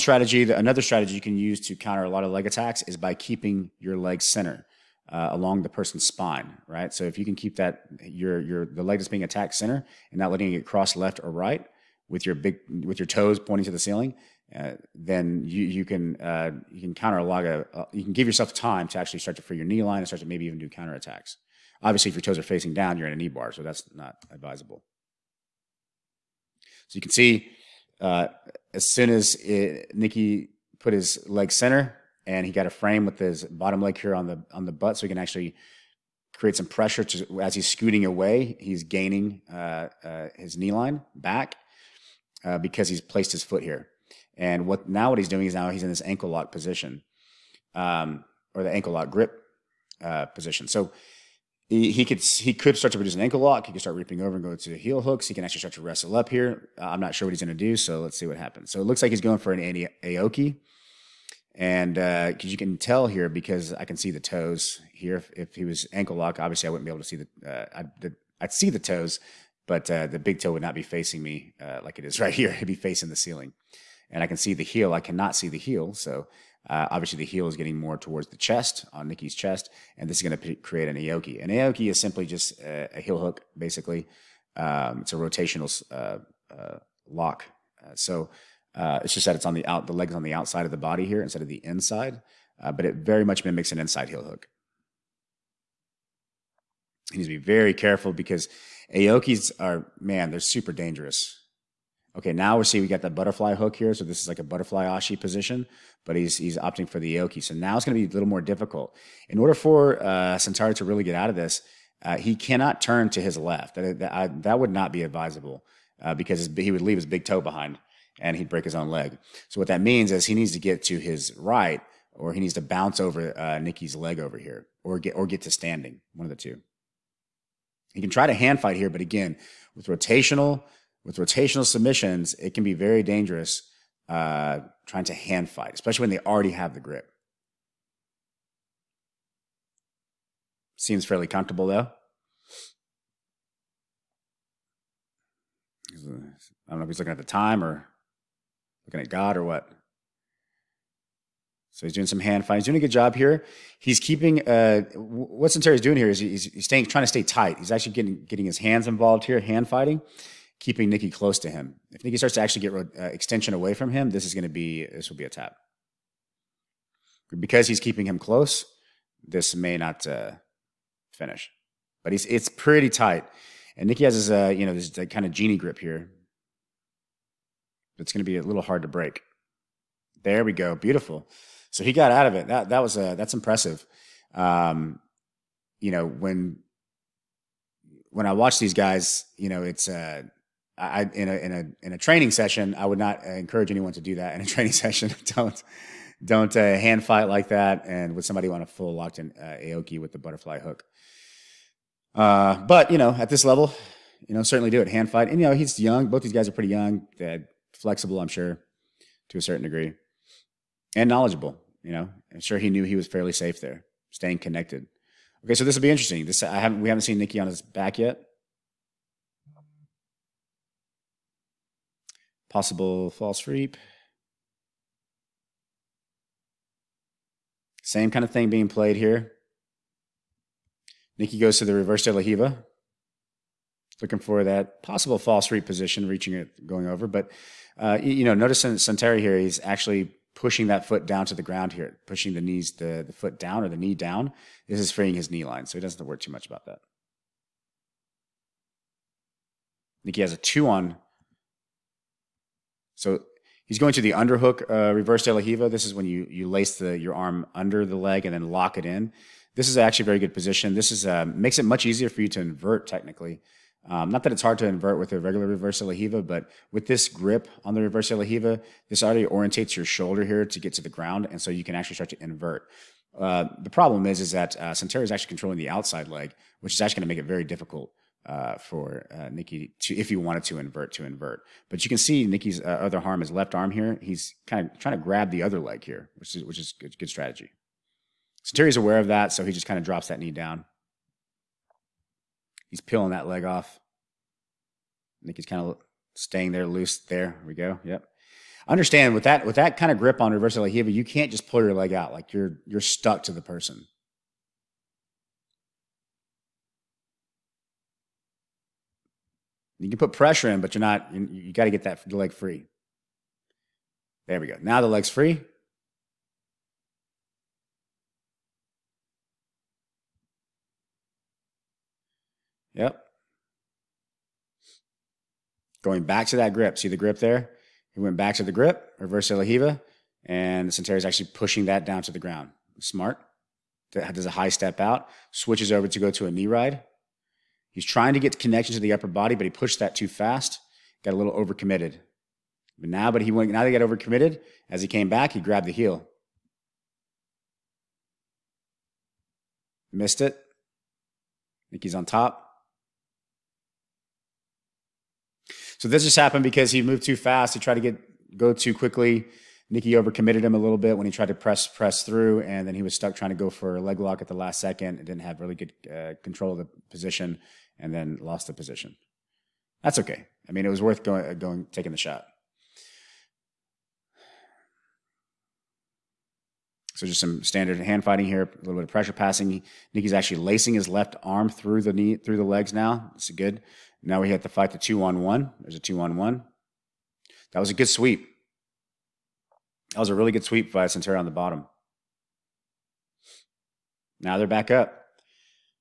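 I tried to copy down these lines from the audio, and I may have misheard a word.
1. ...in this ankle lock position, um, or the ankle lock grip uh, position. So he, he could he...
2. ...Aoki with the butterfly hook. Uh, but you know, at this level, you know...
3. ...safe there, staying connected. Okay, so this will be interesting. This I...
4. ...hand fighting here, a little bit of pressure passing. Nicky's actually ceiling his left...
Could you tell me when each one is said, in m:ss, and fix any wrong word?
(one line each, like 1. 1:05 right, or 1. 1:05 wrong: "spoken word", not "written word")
1. 0:45 right
2. 3:19 right
3. 3:33 right
4. 6:17 wrong: "lacing", not "ceiling".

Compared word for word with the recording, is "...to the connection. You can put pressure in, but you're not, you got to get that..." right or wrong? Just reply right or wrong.
wrong.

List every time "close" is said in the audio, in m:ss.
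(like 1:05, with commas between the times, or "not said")
2:41, 2:48.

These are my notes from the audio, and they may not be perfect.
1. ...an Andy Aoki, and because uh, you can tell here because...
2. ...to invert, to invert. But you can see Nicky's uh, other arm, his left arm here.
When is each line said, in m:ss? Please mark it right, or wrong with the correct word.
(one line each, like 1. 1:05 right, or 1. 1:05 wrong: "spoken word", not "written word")
1. 0:59 right
2. 4:40 right.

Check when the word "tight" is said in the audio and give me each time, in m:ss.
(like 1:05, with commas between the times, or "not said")
2:37, 2:52.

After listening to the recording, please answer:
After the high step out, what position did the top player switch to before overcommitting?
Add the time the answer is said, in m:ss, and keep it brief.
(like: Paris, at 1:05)
knee ride, at 5:36.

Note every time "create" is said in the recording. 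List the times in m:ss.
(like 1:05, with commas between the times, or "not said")
0:36, 1:20.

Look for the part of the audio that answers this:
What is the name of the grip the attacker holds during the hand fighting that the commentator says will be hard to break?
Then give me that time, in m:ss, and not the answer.
2:55.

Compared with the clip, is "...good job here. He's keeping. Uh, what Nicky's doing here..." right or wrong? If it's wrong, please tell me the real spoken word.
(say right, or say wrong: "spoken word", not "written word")
wrong: "Santeri", not "Nicky".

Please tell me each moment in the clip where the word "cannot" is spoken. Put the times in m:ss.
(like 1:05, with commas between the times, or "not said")
1:15, 1:52.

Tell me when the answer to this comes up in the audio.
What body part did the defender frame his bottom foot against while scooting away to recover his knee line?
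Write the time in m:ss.
0:34.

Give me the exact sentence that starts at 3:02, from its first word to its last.
That that was uh, that's impressive.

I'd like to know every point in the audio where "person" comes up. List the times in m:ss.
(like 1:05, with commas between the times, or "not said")
0:05, 5:03.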